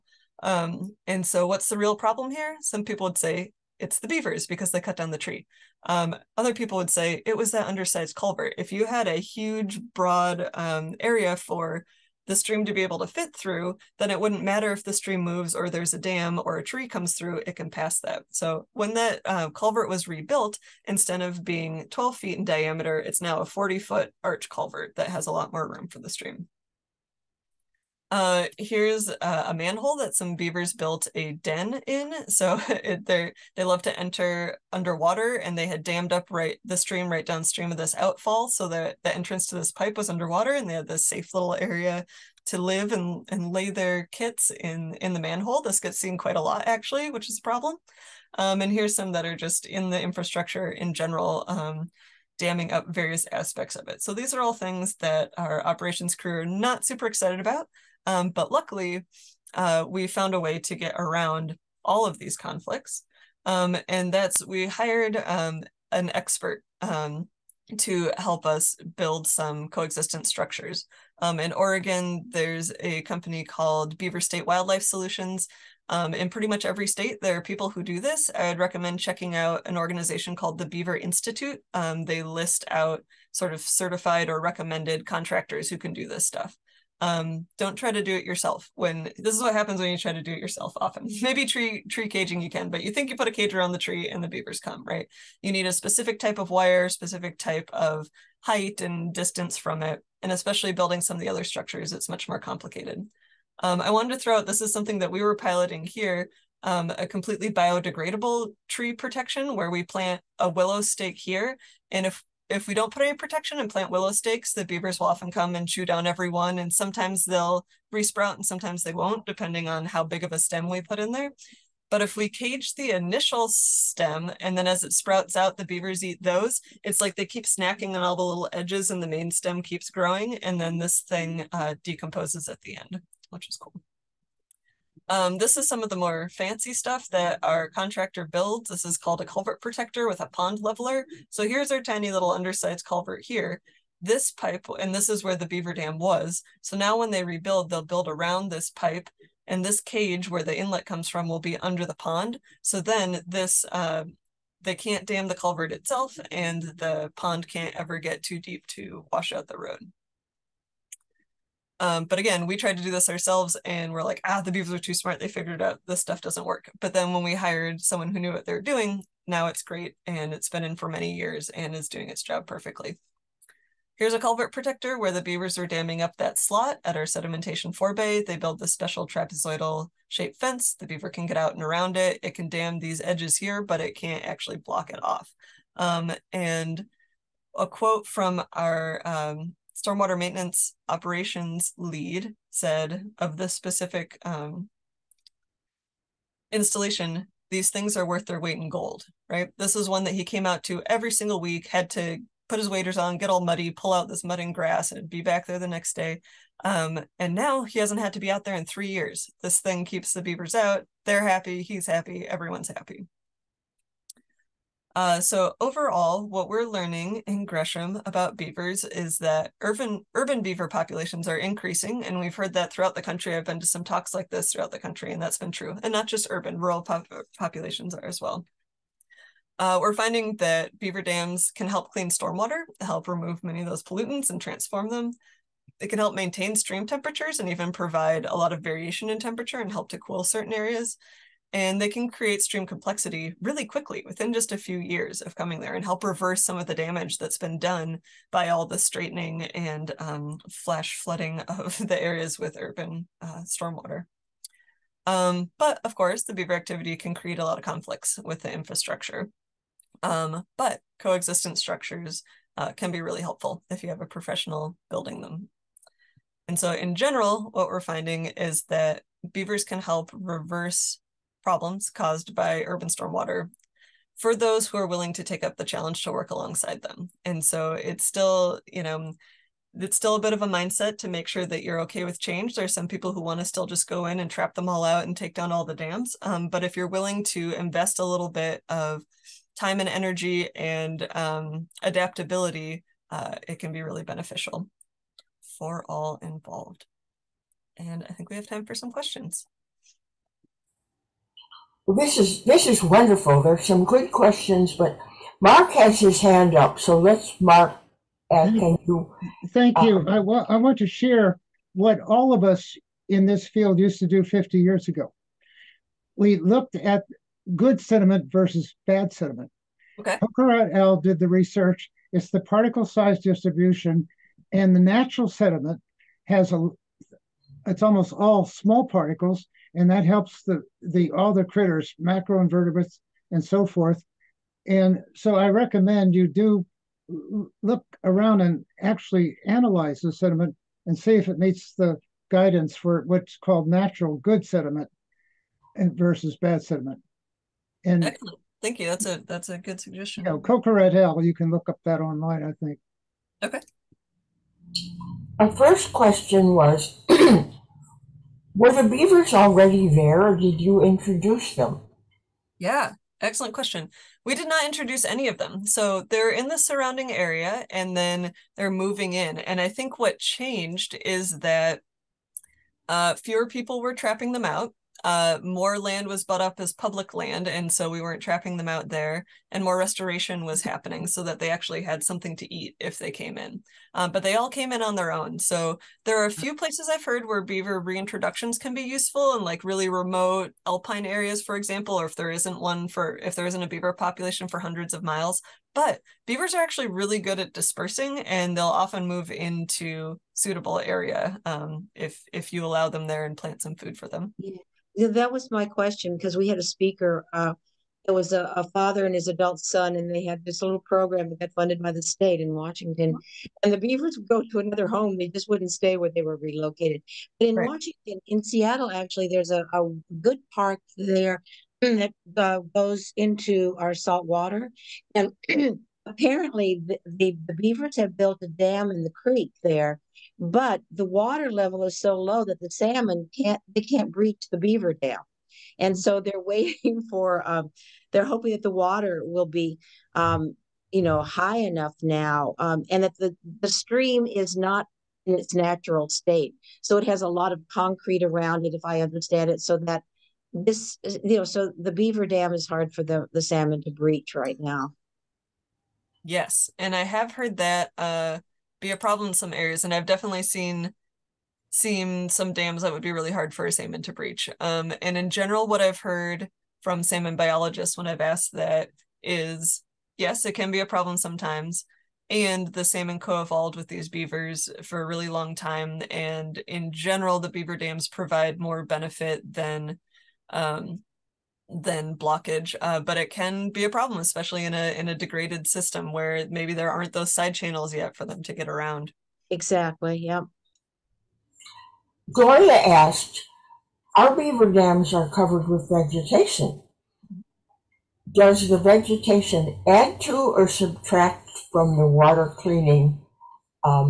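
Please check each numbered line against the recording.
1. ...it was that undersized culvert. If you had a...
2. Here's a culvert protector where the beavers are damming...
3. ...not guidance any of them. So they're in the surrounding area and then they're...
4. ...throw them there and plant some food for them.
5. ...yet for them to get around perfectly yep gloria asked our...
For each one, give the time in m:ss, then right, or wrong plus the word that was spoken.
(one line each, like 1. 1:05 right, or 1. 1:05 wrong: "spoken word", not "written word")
1. 0:07 right
2. 2:53 right
3. 6:04 wrong: "introduce", not "guidance"
4. 6:42 wrong: "allow", not "throw"
5. 8:07 wrong: "exactly", not "perfectly".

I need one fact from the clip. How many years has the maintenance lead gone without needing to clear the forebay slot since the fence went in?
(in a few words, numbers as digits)
3 years.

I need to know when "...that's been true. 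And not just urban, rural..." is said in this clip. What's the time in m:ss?
3:45.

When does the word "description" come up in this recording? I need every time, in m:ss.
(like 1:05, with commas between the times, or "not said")
not said.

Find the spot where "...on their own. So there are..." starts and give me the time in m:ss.
6:24.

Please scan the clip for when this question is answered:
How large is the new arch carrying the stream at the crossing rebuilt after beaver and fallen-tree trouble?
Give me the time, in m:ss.
0:23.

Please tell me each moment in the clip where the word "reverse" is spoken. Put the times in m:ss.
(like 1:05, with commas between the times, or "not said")
4:06, 4:30.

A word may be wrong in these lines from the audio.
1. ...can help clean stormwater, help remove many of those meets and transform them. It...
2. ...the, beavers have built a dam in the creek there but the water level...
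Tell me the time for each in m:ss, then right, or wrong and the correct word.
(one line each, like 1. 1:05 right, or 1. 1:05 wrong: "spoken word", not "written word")
1. 3:51 wrong: "pollutants", not "meets"
2. 7:07 right.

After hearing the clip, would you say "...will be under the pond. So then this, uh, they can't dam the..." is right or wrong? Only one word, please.
right.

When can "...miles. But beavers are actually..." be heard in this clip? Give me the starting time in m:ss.
6:35.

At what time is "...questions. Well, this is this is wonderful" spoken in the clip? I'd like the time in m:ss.
4:58.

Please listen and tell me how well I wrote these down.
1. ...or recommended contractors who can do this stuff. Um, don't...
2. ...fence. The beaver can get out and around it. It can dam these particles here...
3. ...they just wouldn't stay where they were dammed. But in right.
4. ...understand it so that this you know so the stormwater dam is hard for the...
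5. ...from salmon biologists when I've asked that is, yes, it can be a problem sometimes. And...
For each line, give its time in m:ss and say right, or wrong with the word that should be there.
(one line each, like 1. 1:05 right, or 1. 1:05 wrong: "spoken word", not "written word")
1. 1:24 right
2. 3:00 wrong: "edges", not "particles"
3. 6:55 wrong: "relocated", not "dammed"
4. 7:29 wrong: "beaver", not "stormwater"
5. 7:46 right.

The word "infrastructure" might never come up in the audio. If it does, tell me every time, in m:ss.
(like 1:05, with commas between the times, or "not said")
0:50, 4:18.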